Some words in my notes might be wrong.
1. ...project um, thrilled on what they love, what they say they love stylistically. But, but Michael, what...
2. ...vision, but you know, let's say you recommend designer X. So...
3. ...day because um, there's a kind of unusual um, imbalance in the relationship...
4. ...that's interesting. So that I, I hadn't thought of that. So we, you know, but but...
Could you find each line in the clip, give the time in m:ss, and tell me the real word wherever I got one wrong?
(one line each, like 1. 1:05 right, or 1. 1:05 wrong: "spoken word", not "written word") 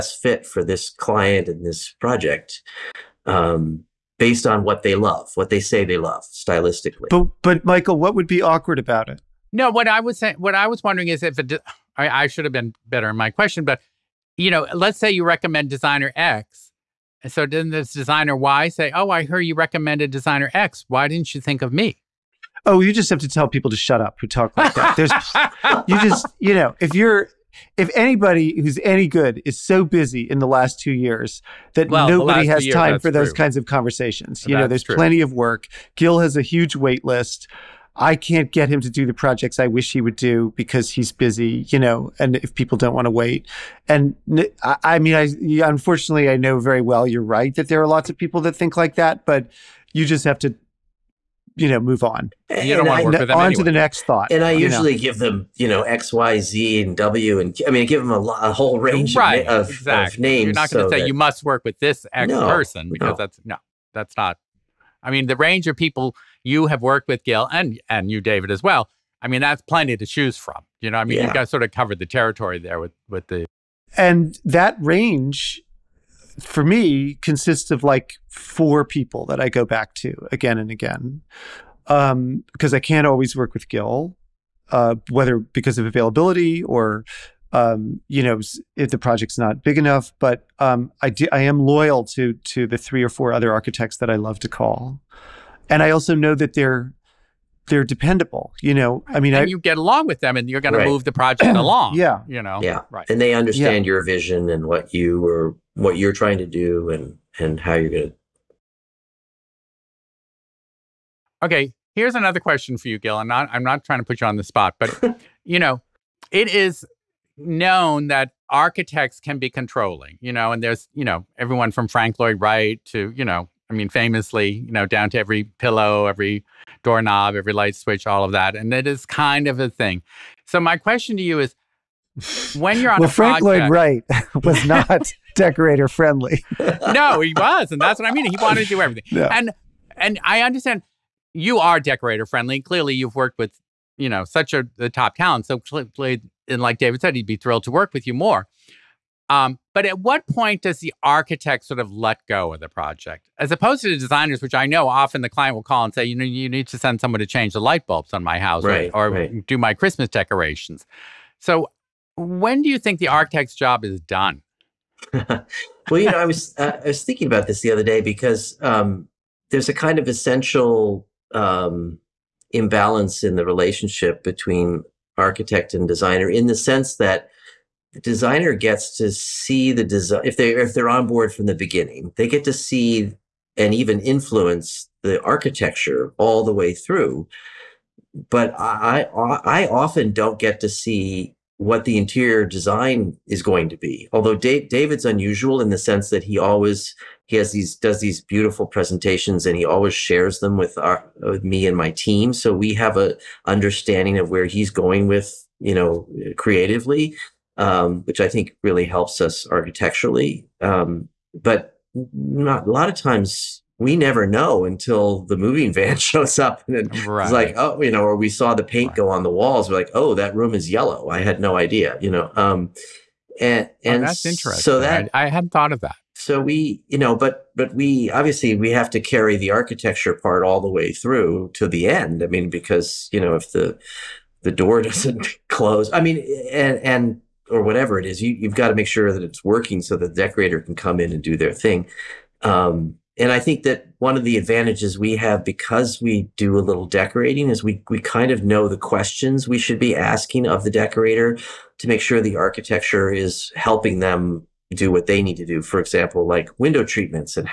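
1. 0:02 wrong: "based", not "thrilled"
2. 0:13 wrong: "question", not "vision"
3. 2:47 wrong: "essential", not "unusual"
4. 3:44 right.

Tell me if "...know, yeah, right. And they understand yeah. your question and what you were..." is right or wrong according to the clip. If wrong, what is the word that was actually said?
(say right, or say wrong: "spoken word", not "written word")
wrong: "vision", not "question".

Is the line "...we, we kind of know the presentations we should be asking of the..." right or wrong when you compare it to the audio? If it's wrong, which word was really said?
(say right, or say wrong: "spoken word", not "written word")
wrong: "questions", not "presentations".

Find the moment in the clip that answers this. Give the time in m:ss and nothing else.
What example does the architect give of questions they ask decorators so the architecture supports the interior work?
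4:16.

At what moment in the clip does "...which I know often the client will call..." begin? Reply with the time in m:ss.
2:34.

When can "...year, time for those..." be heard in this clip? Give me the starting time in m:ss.
0:32.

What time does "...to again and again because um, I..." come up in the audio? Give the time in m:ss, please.
1:19.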